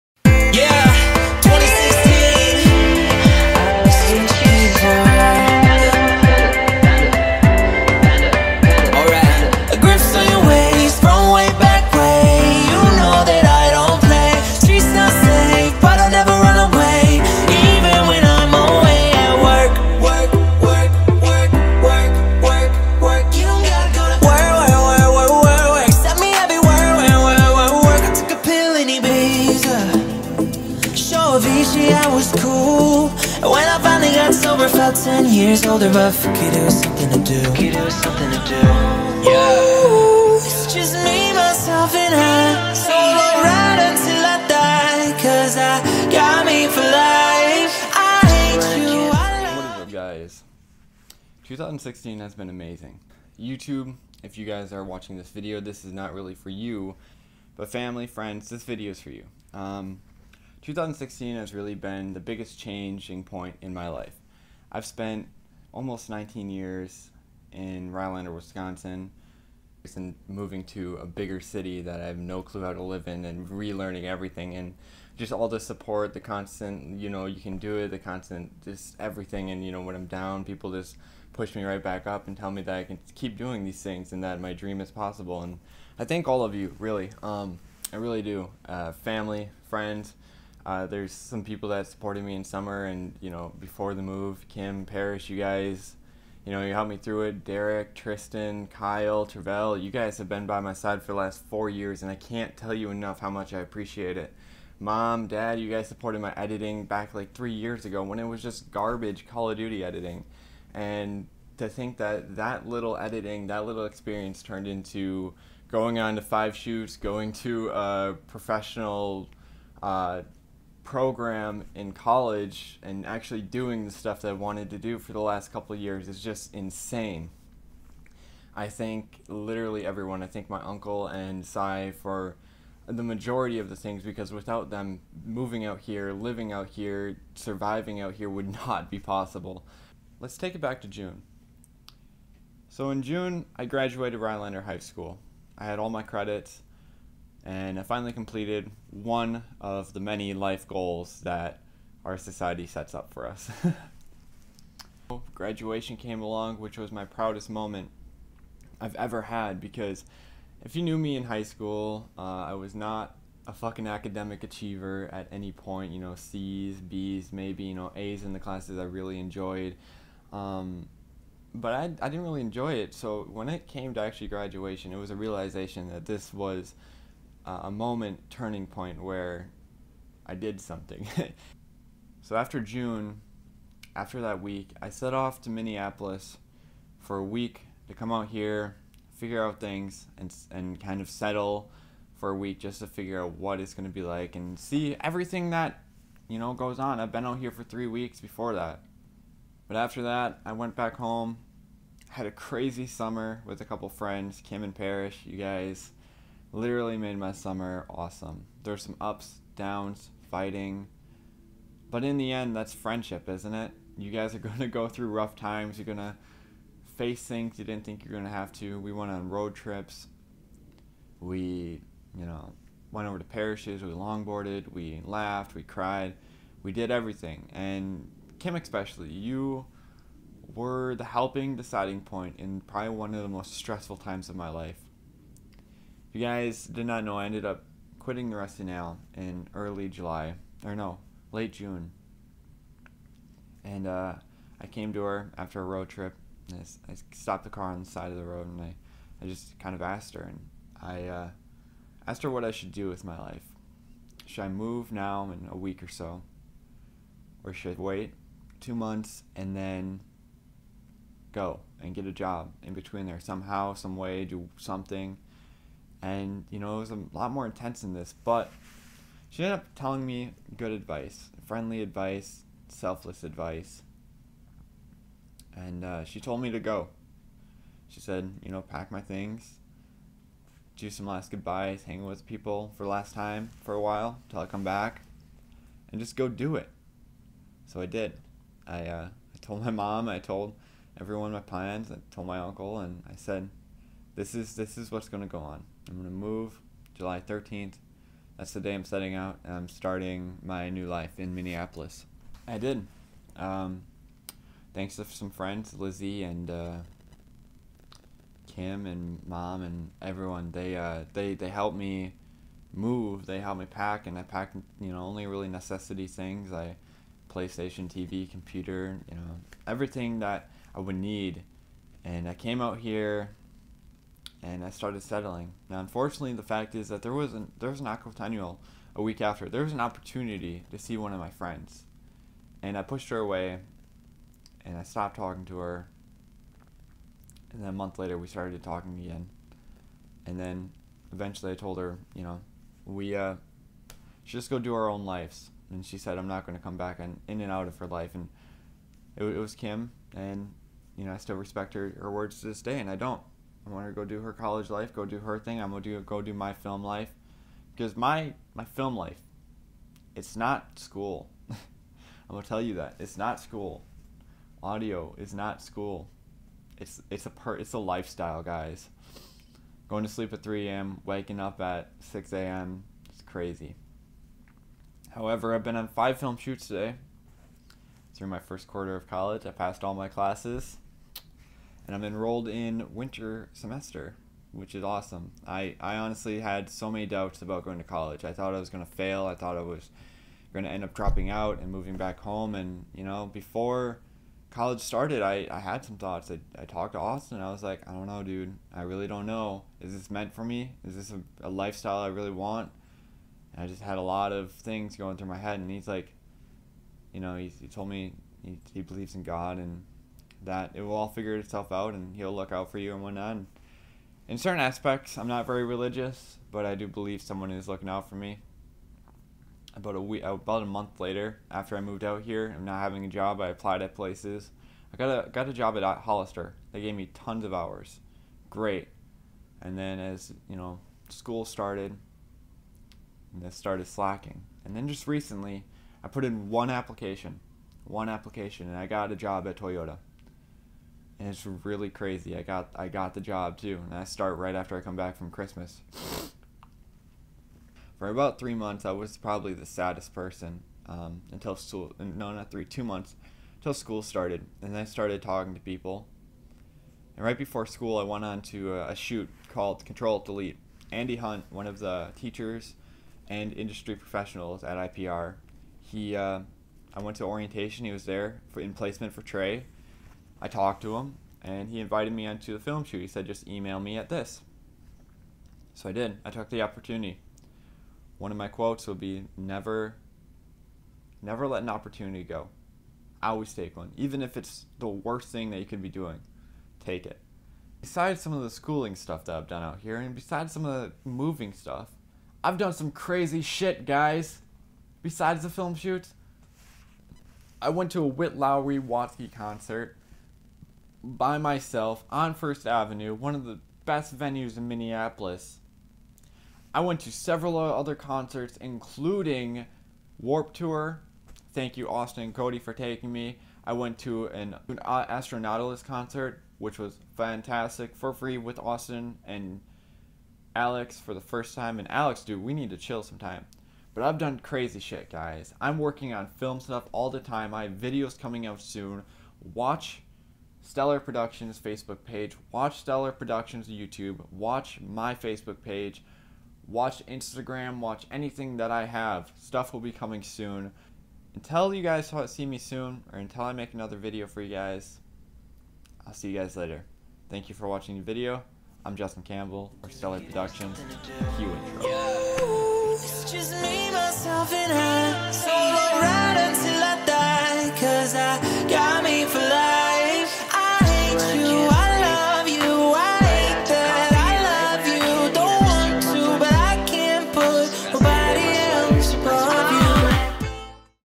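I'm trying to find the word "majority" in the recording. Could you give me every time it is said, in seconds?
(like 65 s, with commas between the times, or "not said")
133 s.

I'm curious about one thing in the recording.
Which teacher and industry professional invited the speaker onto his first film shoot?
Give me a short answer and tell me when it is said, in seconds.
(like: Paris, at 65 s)
Andy Hunt, at 460 s.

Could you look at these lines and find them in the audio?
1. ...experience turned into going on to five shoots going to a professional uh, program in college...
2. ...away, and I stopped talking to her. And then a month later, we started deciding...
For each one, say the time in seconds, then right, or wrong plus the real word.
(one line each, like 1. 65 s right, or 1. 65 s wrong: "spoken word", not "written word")
1. 113 s right
2. 333 s wrong: "talking", not "deciding".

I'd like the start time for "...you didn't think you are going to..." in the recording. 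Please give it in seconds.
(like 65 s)
217 s.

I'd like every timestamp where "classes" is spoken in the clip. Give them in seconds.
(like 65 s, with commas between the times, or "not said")
168 s, 380 s.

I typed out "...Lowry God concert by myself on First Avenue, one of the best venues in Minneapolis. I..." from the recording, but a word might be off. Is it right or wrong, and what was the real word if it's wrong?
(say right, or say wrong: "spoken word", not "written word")
wrong: "Watsky", not "God".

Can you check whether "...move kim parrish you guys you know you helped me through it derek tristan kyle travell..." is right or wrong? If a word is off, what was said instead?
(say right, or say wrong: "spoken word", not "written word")
right.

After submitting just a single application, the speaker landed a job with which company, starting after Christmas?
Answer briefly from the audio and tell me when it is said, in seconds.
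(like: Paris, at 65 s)
Toyota, at 439 s.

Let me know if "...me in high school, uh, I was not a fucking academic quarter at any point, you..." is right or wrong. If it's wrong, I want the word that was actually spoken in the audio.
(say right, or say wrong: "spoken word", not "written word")
wrong: "achiever", not "quarter".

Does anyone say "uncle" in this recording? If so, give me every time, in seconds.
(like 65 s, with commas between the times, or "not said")
130 s, 292 s.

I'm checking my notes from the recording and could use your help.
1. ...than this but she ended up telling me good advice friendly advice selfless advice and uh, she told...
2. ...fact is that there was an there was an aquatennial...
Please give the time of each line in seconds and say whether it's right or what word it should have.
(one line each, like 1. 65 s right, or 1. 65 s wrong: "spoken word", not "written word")
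1. 267 s right
2. 326 s right.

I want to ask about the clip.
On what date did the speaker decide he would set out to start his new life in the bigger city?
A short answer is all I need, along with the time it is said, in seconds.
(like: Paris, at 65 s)
July 13th, at 296 s.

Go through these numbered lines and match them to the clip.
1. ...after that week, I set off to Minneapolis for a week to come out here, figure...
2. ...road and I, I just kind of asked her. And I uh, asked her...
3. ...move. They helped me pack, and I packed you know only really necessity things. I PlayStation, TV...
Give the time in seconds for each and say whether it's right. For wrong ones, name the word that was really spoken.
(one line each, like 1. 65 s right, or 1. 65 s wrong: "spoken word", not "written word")
1. 183 s right
2. 248 s right
3. 312 s right.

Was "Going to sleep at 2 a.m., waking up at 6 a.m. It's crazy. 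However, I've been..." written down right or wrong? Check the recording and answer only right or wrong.
wrong.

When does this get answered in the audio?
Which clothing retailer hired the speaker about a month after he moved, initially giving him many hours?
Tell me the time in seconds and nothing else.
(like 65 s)
425 s.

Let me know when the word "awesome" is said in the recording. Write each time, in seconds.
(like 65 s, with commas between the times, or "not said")
207 s, 384 s.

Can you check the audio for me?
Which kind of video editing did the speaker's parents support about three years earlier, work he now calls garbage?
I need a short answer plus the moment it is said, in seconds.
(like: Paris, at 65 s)
Call of Duty editing, at 109 s.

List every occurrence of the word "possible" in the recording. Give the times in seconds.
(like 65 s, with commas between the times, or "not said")
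84 s, 138 s.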